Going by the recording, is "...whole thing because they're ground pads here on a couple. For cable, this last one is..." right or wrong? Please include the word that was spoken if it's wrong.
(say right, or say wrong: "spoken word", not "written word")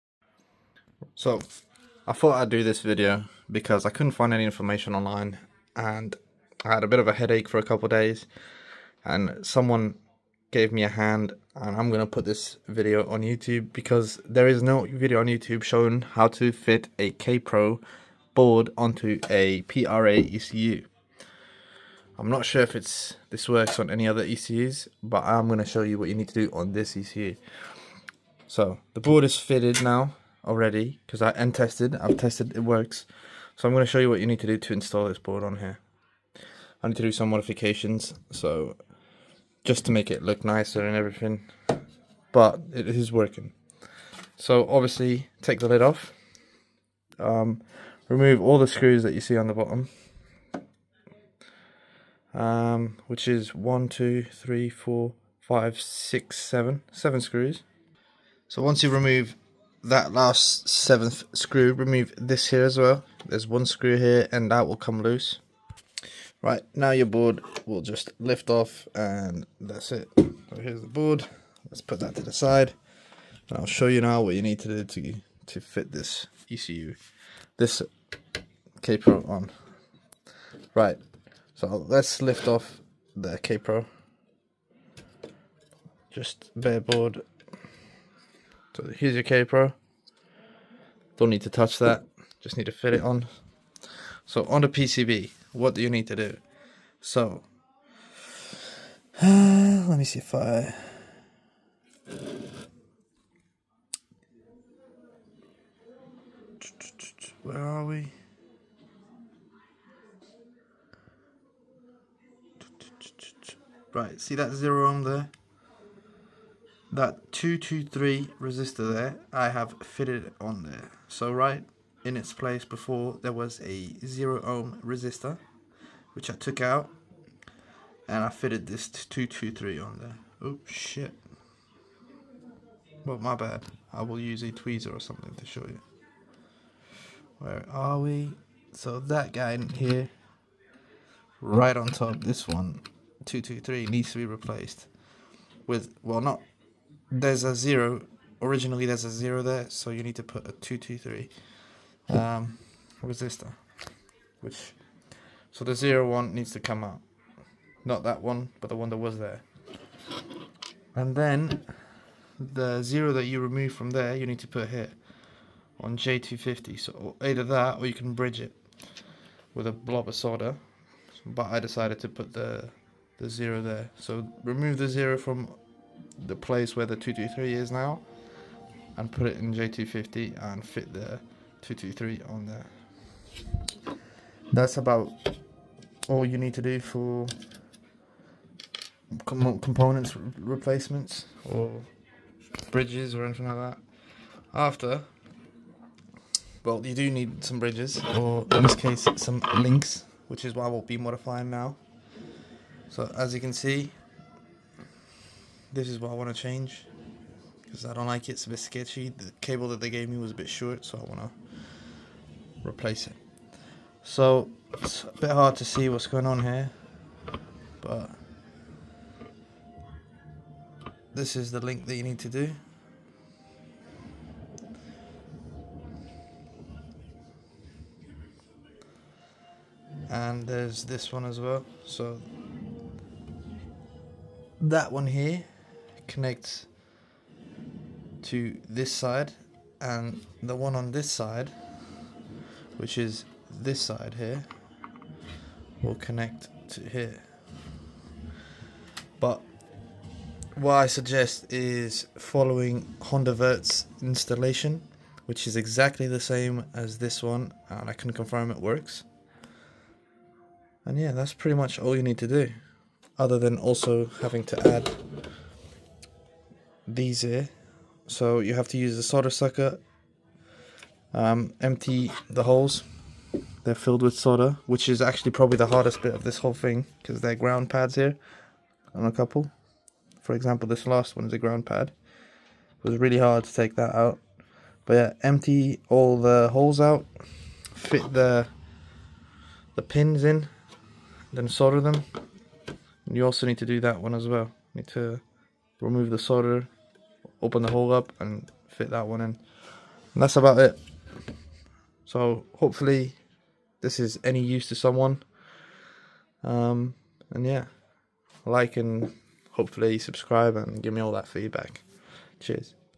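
wrong: "example", not "cable".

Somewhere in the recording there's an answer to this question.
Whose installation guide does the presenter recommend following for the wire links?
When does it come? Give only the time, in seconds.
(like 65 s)
252 s.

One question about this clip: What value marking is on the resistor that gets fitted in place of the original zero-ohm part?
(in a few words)
223.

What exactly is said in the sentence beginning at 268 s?
So you have to use a solder sucker, um, empty the holes.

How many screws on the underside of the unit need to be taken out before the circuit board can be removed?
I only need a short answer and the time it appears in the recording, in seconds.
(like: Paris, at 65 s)
7, at 56 s.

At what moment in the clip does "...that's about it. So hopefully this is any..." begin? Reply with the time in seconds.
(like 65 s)
300 s.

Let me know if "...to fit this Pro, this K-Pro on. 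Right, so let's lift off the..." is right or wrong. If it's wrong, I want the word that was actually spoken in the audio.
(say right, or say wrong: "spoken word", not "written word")
wrong: "ECU", not "Pro".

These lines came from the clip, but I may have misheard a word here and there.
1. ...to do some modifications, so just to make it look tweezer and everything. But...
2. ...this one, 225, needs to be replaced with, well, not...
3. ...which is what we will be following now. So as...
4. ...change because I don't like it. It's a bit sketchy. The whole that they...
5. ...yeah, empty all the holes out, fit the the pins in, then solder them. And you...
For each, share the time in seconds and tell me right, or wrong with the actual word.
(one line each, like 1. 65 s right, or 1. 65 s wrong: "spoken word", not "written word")
1. 36 s wrong: "nicer", not "tweezer"
2. 142 s wrong: "223", not "225"
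3. 200 s wrong: "modifying", not "following"
4. 206 s wrong: "cable", not "whole"
5. 284 s right.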